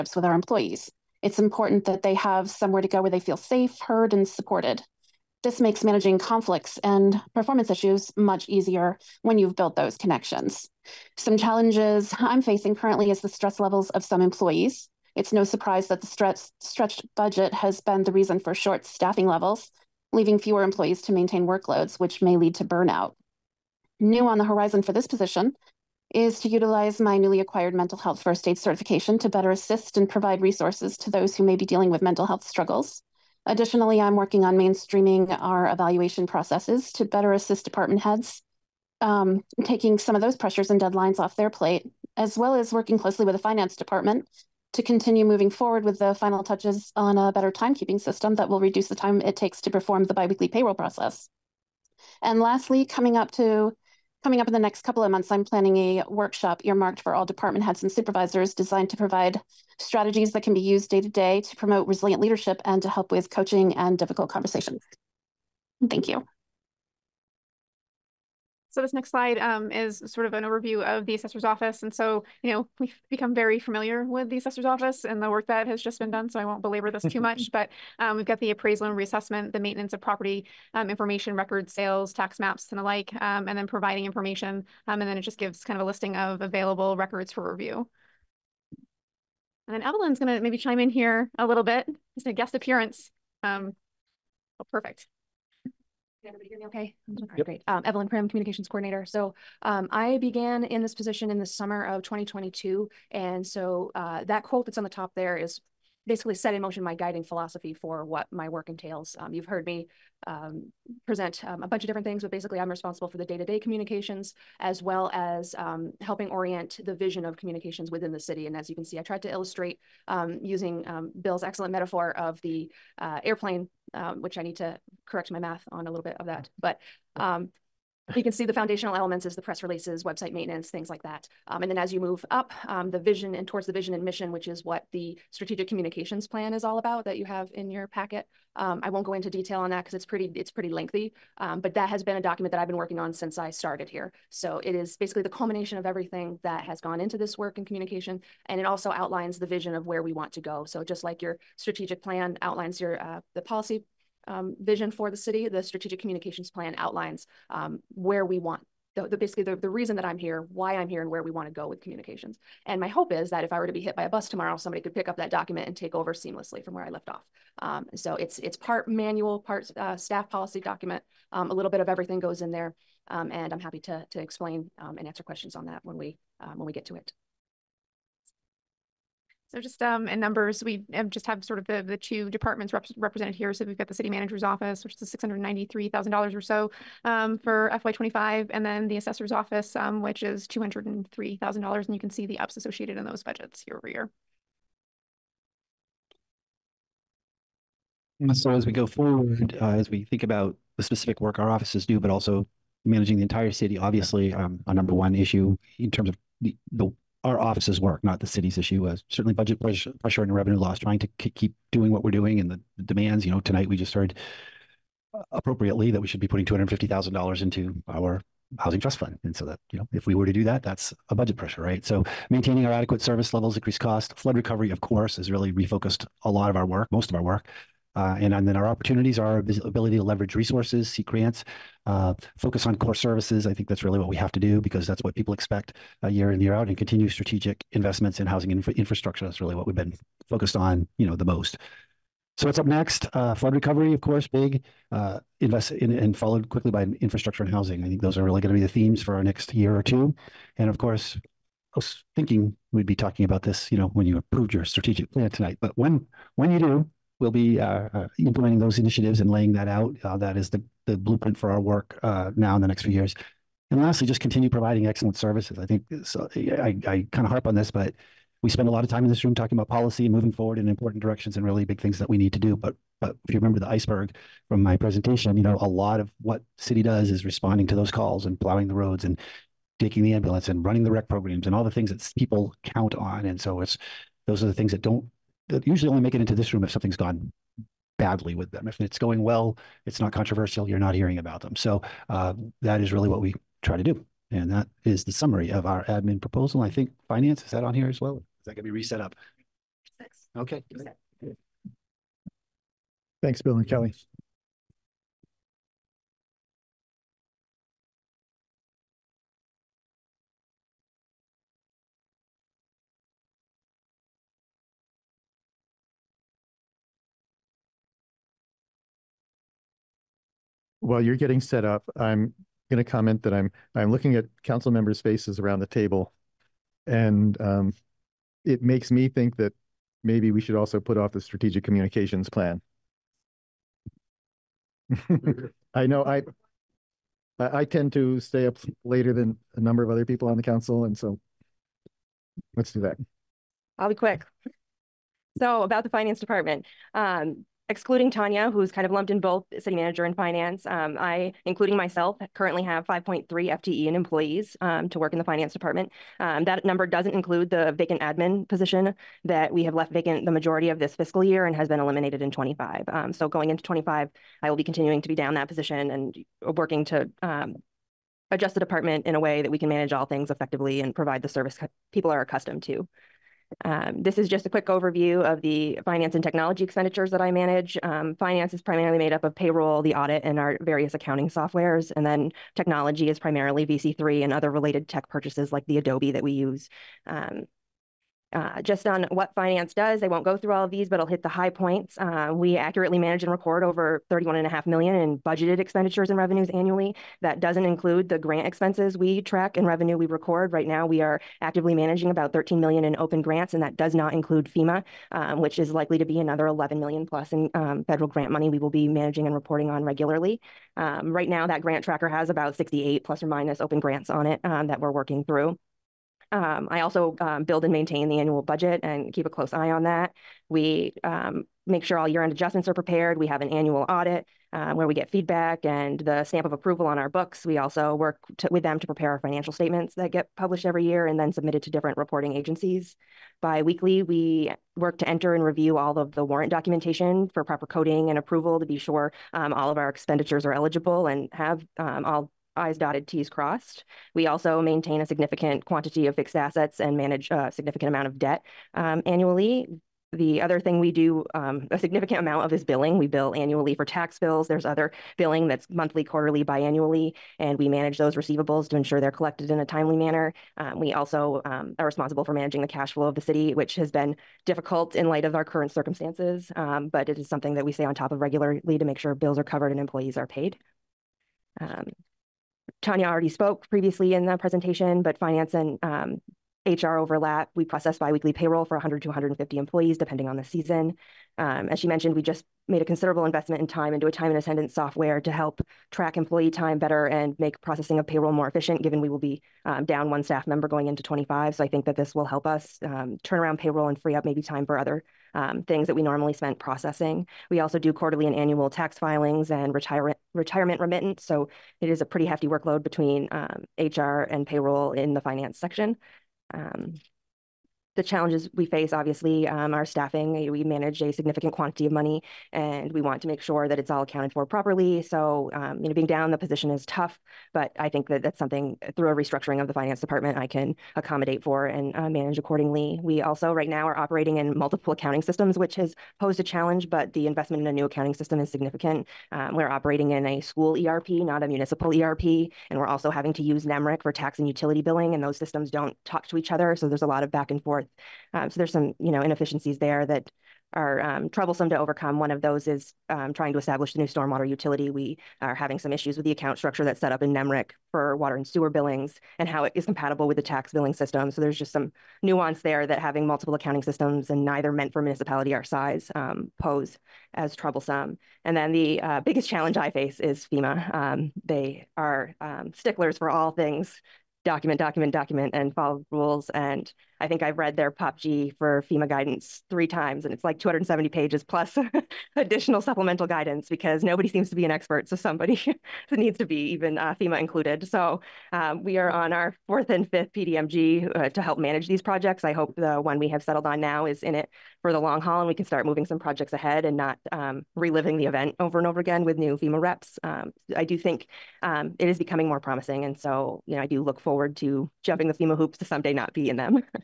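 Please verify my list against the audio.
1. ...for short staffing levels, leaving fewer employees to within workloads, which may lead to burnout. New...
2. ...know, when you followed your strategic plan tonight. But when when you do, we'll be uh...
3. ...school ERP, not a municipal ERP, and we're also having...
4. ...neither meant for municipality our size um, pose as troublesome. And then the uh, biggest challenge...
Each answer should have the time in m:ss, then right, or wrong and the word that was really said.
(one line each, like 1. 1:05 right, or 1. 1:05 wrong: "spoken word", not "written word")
1. 0:18 wrong: "maintain", not "within"
2. 4:13 wrong: "approved", not "followed"
3. 8:50 right
4. 9:14 right.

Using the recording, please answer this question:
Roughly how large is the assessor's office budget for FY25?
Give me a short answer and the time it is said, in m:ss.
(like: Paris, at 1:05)
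$203,000, at 3:10.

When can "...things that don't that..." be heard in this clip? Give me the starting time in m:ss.
4:44.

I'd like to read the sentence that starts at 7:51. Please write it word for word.
Um, Tanya already spoke previously in the presentation, but finance and um, HR overlap.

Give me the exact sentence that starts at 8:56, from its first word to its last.
So there's a lot of back and forth.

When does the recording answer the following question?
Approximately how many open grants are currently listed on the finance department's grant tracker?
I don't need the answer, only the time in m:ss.
6:52.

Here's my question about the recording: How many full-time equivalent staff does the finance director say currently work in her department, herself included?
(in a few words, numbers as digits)
5.3.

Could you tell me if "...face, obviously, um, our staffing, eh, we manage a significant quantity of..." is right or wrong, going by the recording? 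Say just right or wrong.
right.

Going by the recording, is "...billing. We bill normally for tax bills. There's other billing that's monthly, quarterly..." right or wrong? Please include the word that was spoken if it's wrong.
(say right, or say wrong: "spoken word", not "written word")
wrong: "annually", not "normally".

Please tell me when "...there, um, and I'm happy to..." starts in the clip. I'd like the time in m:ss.
2:52.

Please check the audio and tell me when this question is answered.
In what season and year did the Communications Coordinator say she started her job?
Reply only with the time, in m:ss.
1:41.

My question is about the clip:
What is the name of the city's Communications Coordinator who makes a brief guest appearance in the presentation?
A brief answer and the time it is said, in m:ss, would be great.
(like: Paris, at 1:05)
Evelyn Prim, at 1:37.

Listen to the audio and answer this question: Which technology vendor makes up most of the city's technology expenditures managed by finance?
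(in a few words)
VC3.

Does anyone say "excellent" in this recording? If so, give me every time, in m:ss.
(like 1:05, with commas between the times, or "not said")
2:01, 4:24.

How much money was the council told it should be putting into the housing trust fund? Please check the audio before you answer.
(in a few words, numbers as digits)
$250,000.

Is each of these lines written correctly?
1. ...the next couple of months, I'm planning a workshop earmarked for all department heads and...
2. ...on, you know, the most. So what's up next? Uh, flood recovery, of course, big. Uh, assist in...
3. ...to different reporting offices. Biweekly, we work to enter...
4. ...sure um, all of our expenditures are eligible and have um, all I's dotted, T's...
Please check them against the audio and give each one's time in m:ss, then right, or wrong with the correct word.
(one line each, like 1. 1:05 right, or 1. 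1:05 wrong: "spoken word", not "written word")
1. 0:54 right
2. 4:00 wrong: "invest", not "assist"
3. 7:11 wrong: "agencies", not "offices"
4. 7:18 right.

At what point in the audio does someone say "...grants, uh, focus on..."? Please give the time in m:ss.
3:51.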